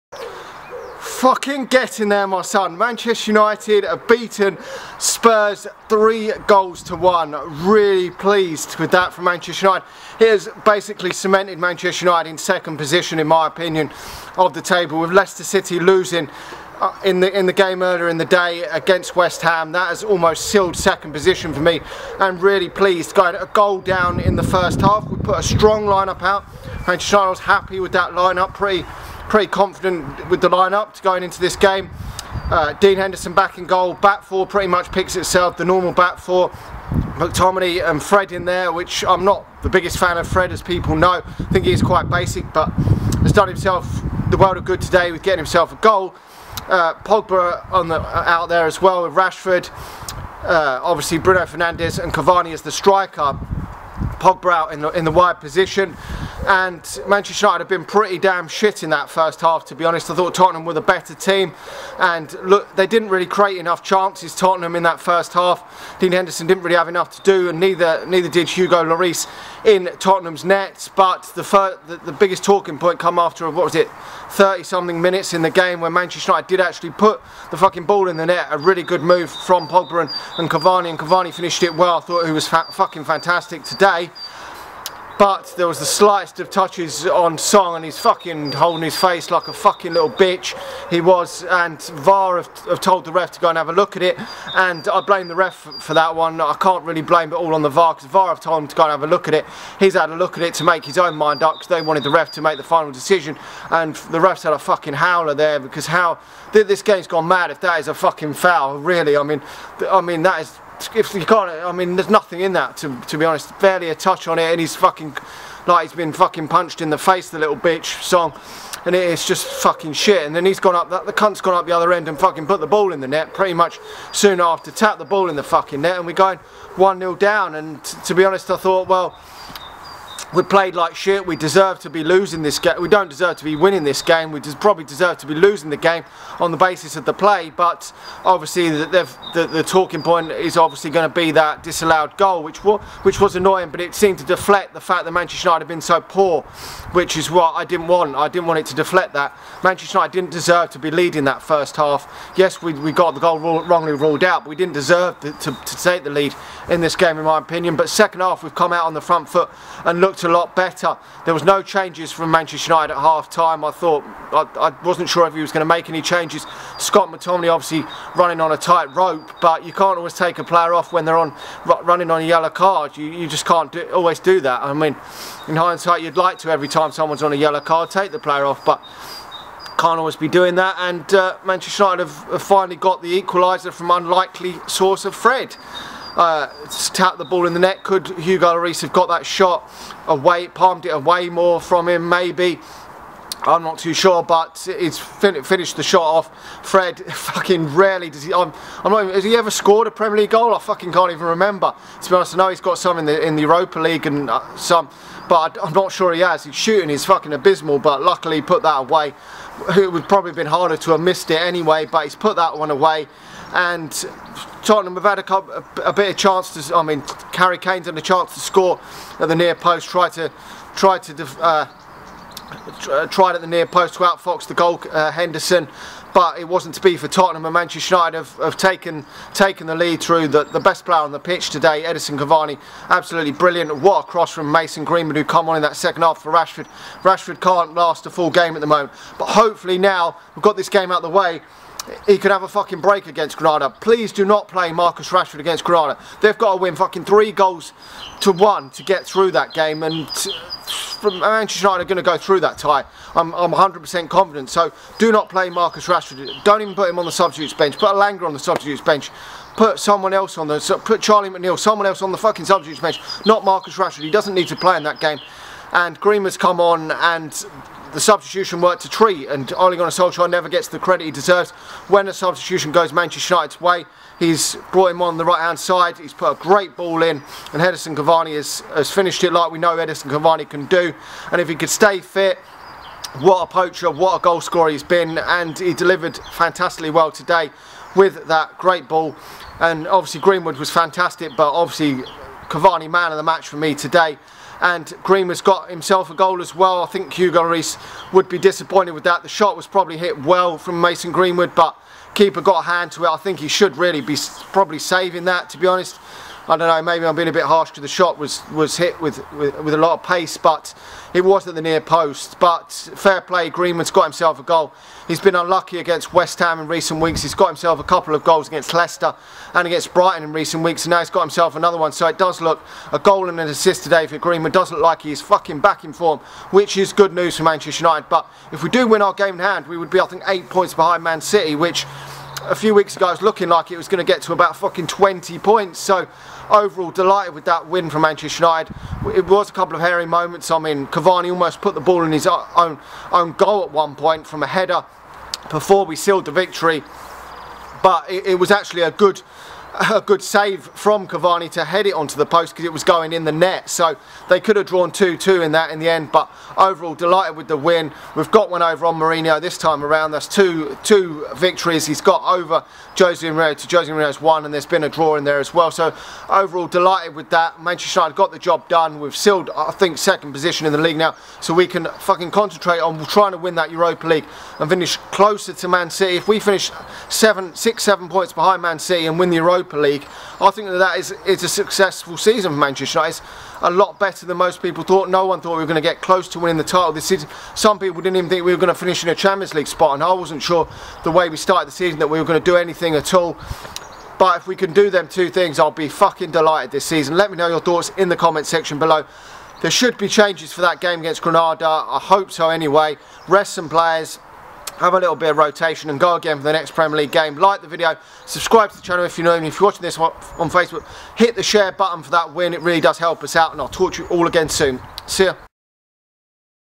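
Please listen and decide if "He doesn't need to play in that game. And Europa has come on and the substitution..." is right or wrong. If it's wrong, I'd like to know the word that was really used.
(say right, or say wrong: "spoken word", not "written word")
wrong: "Green", not "Europa".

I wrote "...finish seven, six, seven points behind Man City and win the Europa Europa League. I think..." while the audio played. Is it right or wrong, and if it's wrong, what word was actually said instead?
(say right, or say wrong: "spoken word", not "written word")
right.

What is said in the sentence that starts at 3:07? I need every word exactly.
Could Hugo Lloris have got that shot away, palmed it away more from him maybe?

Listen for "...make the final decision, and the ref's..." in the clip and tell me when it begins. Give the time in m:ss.
1:42.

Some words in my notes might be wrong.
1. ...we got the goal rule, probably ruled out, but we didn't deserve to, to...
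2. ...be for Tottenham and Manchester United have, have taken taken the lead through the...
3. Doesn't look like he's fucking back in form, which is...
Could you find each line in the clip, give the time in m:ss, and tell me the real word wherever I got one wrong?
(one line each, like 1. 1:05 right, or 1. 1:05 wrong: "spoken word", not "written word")
1. 2:32 wrong: "wrongly", not "probably"
2. 3:46 right
3. 5:24 right.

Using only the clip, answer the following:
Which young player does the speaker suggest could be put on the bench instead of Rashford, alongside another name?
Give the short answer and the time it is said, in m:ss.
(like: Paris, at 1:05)
Charlie McNeill, at 4:21.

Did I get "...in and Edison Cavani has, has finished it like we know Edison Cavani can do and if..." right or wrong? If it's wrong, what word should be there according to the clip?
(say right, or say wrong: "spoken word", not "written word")
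right.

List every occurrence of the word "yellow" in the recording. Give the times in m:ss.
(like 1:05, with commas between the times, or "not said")
2:52, 2:57.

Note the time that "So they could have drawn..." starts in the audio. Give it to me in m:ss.
5:53.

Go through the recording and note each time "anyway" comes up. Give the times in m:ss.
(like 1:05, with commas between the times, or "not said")
3:31, 6:42.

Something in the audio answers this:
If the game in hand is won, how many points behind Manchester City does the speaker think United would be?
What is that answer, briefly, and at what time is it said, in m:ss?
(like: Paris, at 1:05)
8, at 5:30.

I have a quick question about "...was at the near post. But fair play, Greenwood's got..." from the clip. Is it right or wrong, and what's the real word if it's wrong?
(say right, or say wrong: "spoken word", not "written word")
right.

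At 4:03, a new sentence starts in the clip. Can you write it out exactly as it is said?
Please do not play Marcus Rashford against Granada.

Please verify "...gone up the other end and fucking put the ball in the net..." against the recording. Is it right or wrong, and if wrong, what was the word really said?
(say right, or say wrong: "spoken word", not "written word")
right.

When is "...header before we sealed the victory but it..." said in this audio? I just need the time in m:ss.
5:44.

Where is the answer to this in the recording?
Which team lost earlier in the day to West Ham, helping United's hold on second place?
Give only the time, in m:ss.
0:15.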